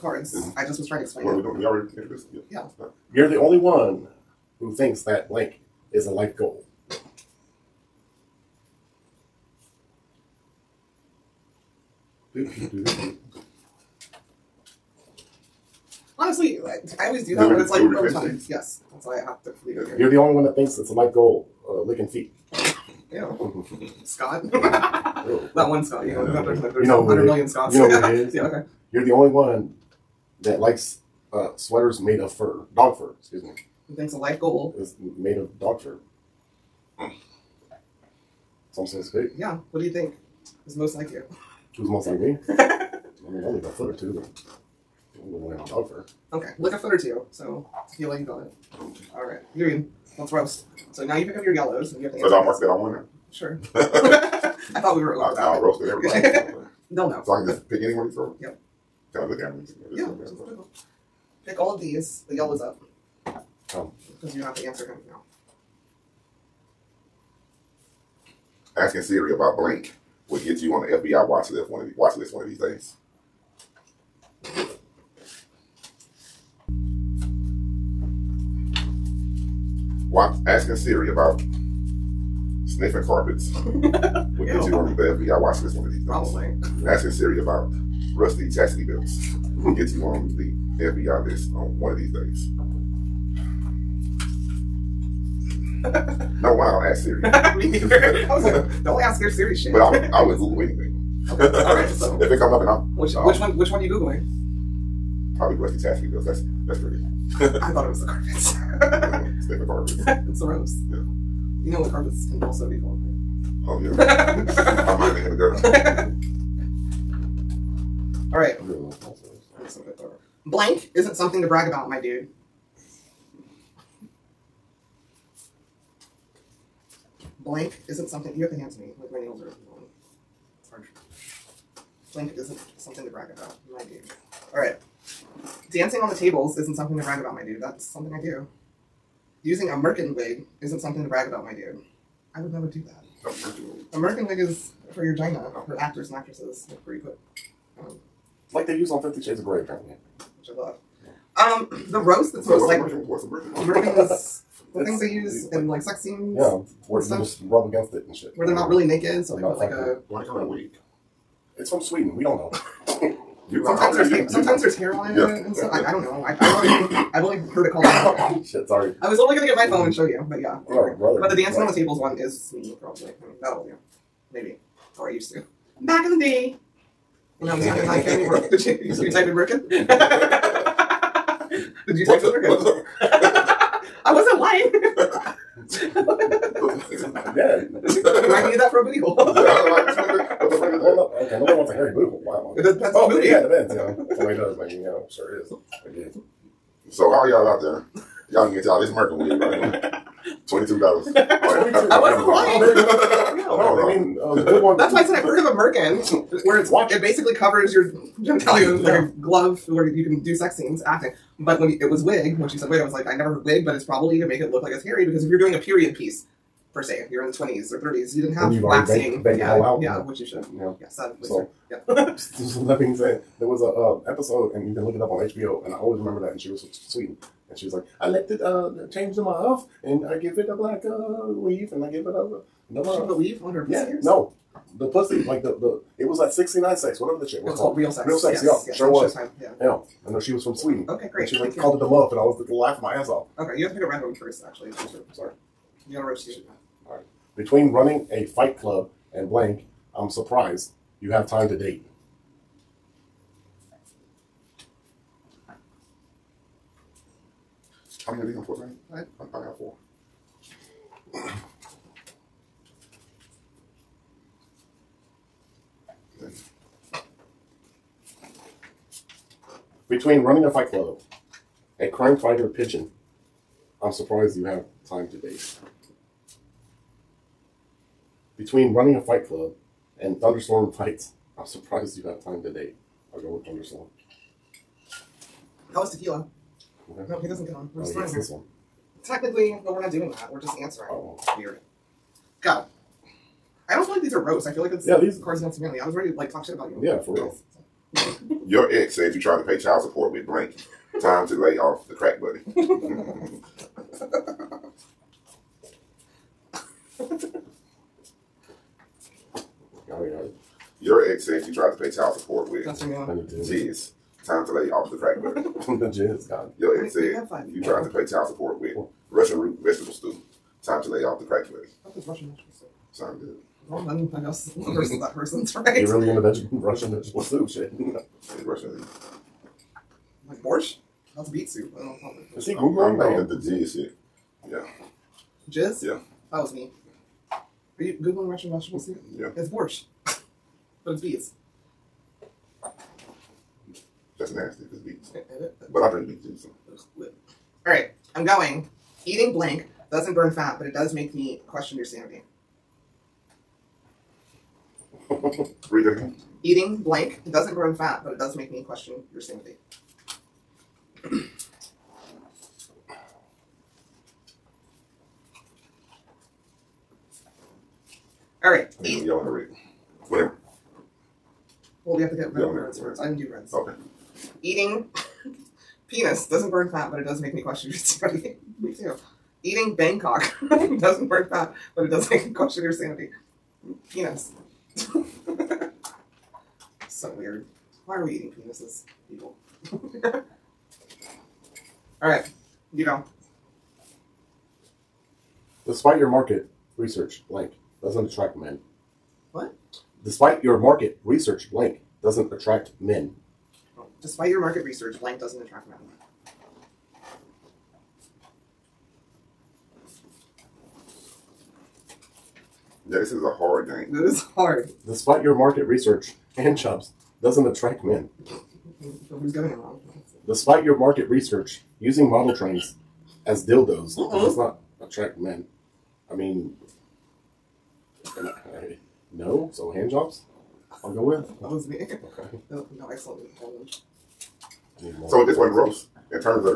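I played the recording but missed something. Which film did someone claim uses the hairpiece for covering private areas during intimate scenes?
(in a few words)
Fifty Shades of Grey.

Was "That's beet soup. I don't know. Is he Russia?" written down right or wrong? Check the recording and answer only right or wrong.
wrong.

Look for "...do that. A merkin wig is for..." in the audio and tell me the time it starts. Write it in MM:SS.
02:22.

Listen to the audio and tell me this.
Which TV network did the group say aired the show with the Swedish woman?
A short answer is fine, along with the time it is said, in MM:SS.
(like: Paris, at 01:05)
Showtime, at 03:59.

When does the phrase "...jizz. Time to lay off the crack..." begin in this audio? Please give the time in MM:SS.
05:12.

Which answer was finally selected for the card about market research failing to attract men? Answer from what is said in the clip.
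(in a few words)
Hand jobs.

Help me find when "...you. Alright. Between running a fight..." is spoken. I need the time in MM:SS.
04:06.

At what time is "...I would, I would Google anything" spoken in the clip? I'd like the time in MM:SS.
01:39.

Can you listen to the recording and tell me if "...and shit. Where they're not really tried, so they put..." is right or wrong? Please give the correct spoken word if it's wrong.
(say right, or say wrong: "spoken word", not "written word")
wrong: "naked", not "tried".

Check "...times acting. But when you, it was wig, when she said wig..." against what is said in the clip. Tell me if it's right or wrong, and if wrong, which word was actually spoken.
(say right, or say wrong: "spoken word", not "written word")
wrong: "scenes", not "times".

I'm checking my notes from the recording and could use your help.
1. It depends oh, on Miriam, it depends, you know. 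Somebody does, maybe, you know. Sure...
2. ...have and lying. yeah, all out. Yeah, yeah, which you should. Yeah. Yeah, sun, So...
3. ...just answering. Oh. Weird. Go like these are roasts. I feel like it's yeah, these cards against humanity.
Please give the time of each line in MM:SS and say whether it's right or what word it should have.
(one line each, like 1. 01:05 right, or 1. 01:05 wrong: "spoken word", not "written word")
1. 03:12 wrong: "Yeah", not "Miriam"
2. 03:38 wrong: "waxing", not "lying"
3. 04:50 right.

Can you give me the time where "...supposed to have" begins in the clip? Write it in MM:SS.
04:18.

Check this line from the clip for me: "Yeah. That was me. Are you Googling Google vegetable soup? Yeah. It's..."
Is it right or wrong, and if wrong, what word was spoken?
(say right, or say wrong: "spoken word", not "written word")
wrong: "Russian", not "Google".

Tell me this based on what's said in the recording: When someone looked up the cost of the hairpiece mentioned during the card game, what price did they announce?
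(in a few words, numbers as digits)
$22.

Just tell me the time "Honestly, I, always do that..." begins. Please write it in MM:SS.
00:16.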